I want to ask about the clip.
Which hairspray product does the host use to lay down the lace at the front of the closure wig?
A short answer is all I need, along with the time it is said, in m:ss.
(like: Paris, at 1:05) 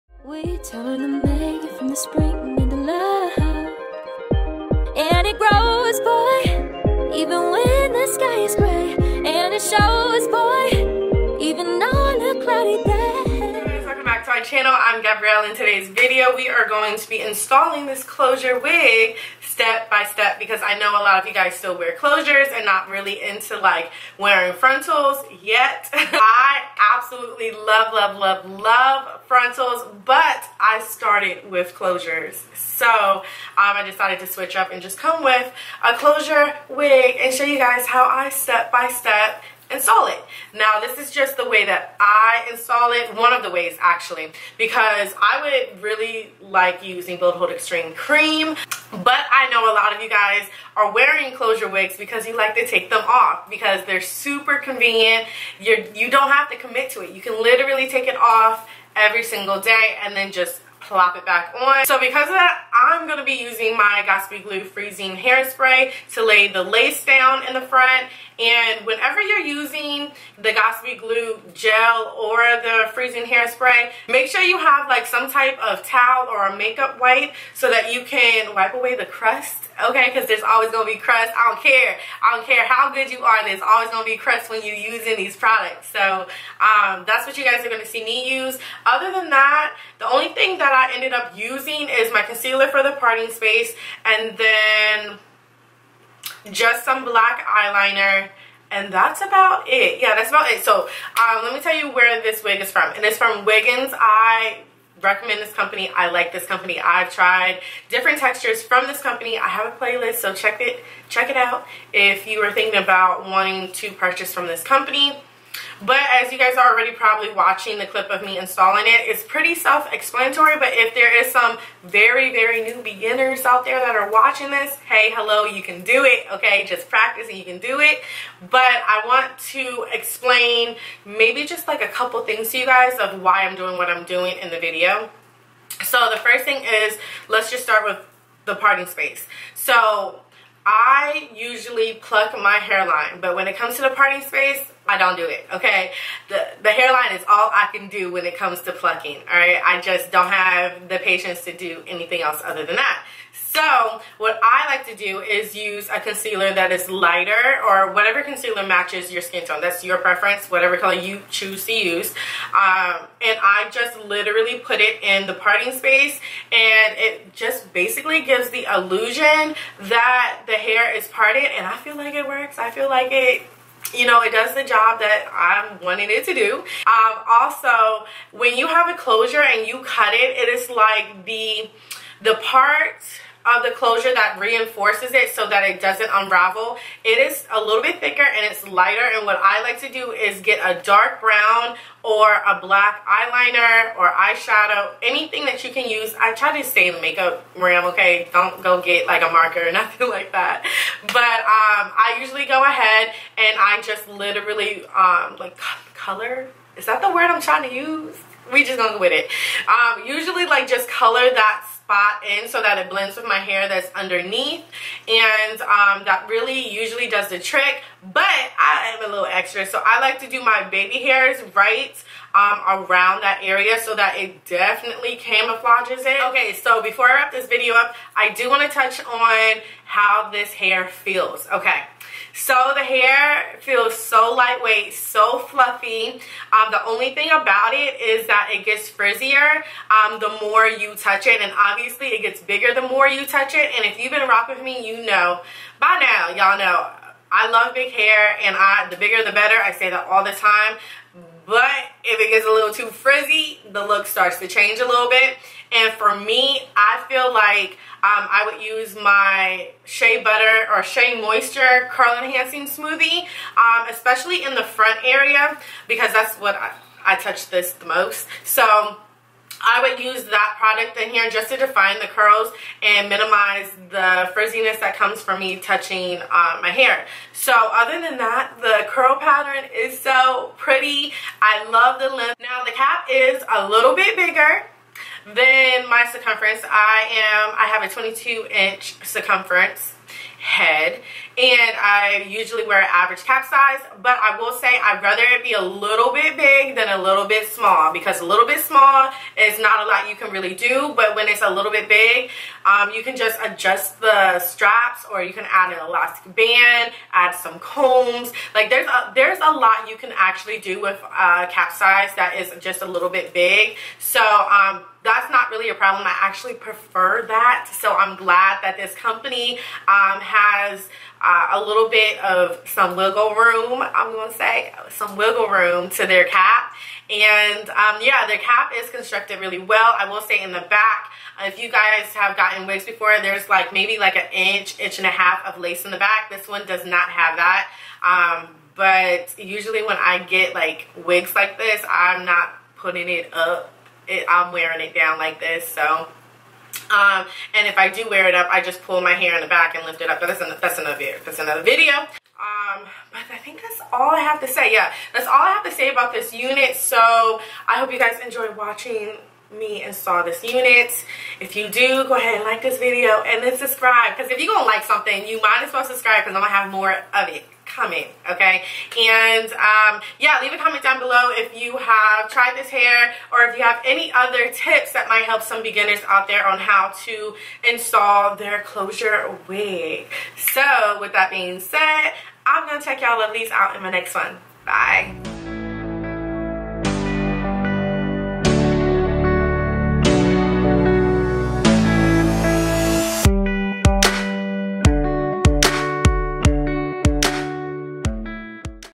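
Got2b Glue Freezing Hairspray, at 1:04.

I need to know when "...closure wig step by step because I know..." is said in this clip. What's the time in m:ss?
0:18.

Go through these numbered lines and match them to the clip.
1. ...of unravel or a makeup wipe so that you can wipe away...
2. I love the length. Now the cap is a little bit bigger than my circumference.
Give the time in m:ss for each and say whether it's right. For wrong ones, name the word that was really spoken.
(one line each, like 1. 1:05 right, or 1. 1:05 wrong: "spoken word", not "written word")
1. 1:15 wrong: "towel", not "unravel"
2. 4:41 right.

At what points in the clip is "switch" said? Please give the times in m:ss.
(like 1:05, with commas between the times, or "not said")
0:34.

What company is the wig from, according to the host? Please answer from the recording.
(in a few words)
Wiggins.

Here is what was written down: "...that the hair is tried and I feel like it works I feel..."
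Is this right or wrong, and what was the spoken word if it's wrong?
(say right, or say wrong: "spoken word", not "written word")
wrong: "parted", not "tried".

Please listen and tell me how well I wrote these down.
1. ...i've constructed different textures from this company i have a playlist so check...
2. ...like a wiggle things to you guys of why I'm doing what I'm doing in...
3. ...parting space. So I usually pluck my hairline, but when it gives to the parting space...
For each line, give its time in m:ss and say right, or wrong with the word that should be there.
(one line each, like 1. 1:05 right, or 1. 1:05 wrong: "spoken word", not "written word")
1. 1:46 wrong: "tried", not "constructed"
2. 2:11 wrong: "couple", not "wiggle"
3. 2:18 wrong: "comes", not "gives".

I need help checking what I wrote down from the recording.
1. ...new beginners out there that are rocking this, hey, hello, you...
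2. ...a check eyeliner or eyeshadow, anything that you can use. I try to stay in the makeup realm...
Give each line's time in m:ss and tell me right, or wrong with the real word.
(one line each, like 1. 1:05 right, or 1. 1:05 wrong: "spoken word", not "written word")
1. 2:02 wrong: "watching", not "rocking"
2. 3:12 wrong: "black", not "check".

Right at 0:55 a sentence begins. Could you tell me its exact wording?
You're, you don't have to commit to it.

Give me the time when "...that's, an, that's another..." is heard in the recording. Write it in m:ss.
5:50.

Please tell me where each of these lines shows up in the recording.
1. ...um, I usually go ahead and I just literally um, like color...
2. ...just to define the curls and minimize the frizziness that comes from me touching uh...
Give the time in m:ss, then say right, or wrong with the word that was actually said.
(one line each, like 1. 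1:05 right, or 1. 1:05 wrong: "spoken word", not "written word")
1. 3:21 right
2. 4:31 right.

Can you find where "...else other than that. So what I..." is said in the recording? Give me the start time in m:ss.
2:32.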